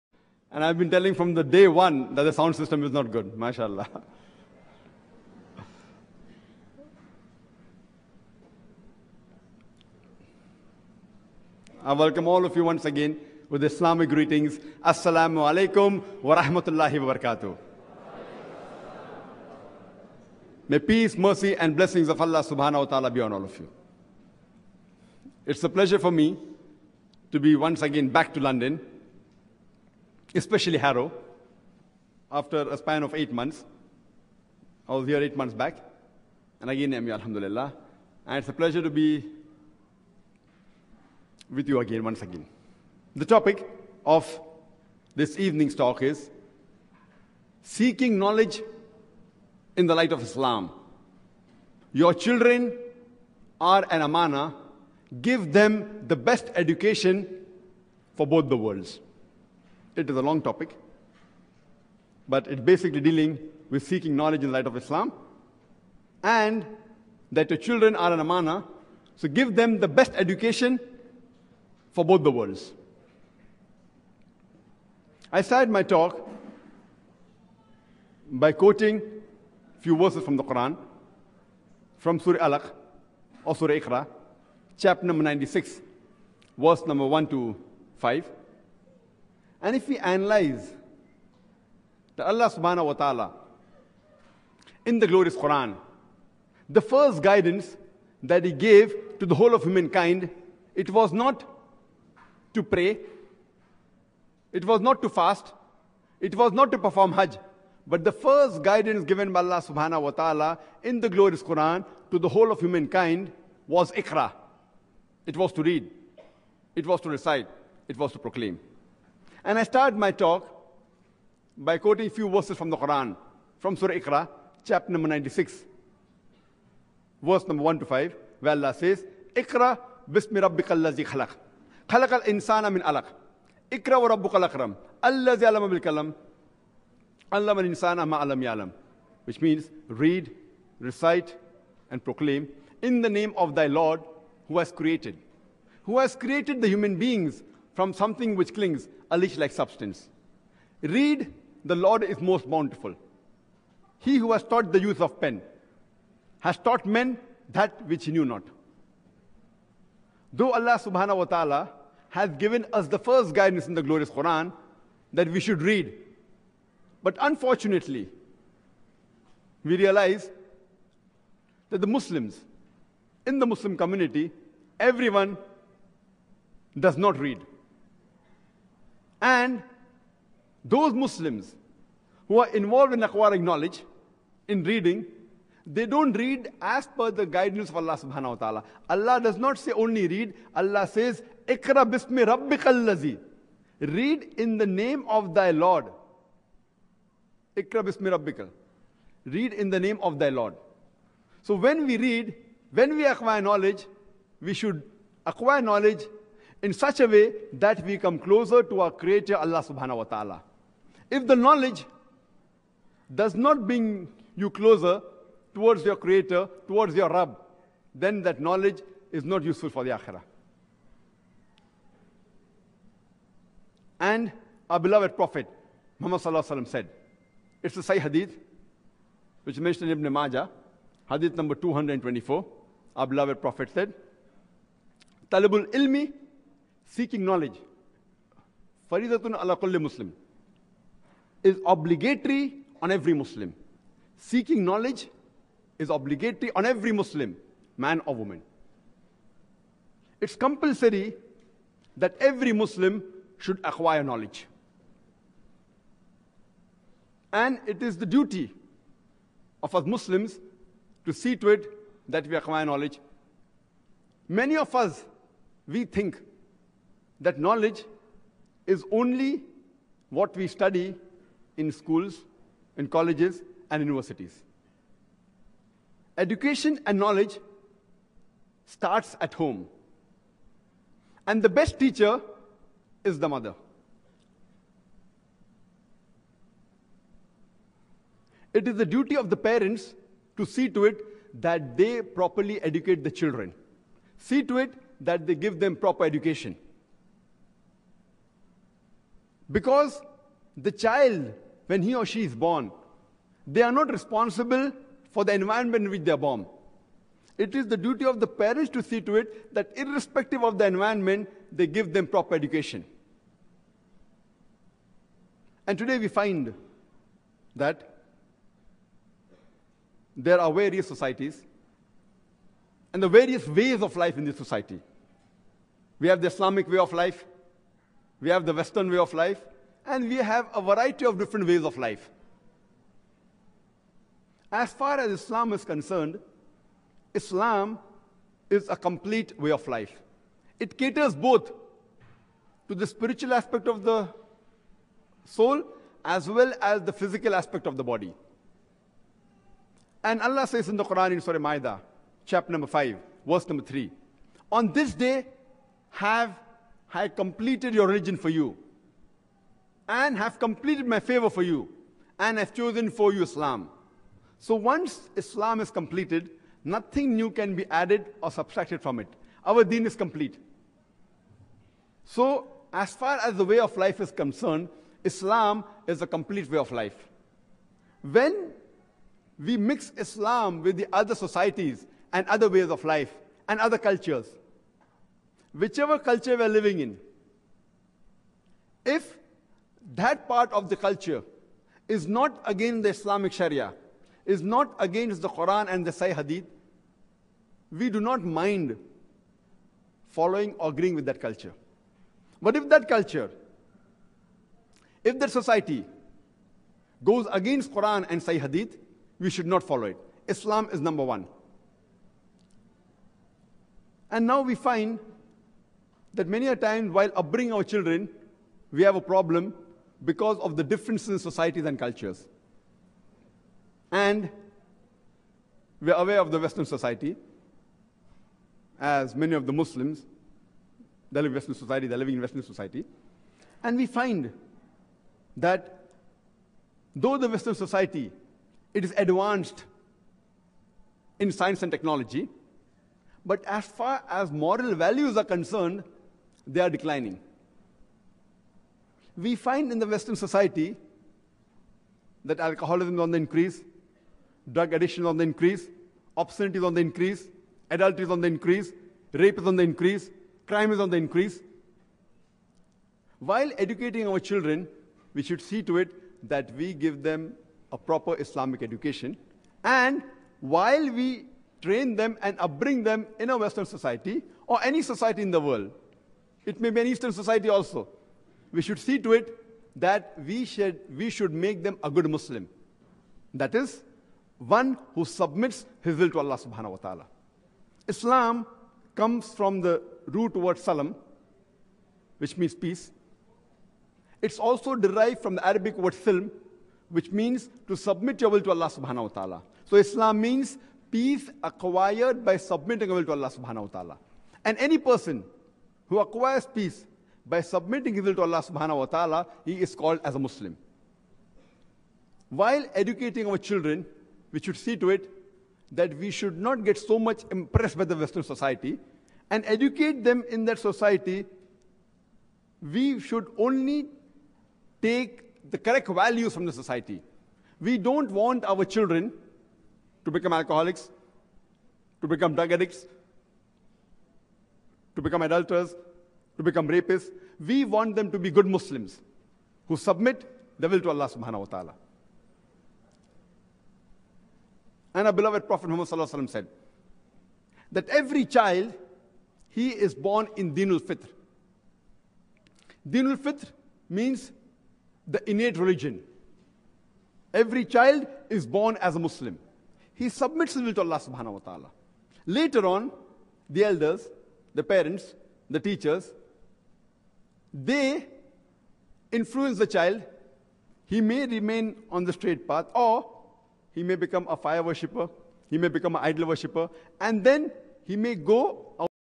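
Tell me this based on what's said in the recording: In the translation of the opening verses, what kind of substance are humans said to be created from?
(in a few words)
A leech like substance.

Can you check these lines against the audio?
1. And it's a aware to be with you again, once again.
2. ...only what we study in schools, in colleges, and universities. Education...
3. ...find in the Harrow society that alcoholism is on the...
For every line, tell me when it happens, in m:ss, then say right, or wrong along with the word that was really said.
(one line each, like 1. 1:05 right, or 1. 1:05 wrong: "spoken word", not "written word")
1. 0:38 wrong: "pleasure", not "aware"
2. 4:28 right
3. 7:29 wrong: "Western", not "Harrow".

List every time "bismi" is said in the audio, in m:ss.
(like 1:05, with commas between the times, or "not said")
2:10, 3:11, 3:17.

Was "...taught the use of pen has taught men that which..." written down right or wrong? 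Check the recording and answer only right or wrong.
right.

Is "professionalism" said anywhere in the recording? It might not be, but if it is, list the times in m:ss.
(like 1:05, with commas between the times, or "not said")
not said.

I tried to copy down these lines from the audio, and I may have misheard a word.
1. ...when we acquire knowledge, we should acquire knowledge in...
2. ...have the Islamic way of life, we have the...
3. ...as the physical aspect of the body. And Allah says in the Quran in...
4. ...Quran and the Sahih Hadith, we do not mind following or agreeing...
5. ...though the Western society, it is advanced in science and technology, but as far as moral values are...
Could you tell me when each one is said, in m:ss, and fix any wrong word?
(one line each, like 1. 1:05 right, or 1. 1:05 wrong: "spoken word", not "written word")
1. 3:22 right
2. 5:26 right
3. 5:46 right
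4. 6:35 right
5. 7:16 right.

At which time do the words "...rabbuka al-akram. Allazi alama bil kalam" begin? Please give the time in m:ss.
2:14.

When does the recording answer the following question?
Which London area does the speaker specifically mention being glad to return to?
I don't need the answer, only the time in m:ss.
0:30.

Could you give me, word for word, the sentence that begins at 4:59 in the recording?
Because the child, when he or she is born, they are not responsible for the environment in which they are born.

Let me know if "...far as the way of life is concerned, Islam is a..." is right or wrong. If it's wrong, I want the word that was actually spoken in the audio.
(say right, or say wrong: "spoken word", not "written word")
right.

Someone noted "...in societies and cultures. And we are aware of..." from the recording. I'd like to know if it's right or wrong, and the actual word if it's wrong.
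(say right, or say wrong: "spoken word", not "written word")
right.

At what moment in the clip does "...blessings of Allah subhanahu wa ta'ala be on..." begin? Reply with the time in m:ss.
0:21.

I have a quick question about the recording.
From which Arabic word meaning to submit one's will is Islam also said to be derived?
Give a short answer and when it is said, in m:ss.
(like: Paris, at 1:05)
silm, at 8:15.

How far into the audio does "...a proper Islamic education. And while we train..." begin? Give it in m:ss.
7:47.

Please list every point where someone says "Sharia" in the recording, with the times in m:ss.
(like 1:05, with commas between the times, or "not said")
6:33.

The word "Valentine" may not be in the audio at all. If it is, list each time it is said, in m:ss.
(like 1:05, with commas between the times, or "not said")
not said.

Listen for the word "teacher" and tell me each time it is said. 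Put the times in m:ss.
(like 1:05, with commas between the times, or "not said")
4:41, 9:25.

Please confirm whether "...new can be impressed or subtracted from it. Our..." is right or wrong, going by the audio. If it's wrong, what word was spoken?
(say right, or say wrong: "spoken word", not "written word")
wrong: "added", not "impressed".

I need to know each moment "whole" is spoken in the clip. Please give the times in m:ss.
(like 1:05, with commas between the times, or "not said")
1:39, 1:52.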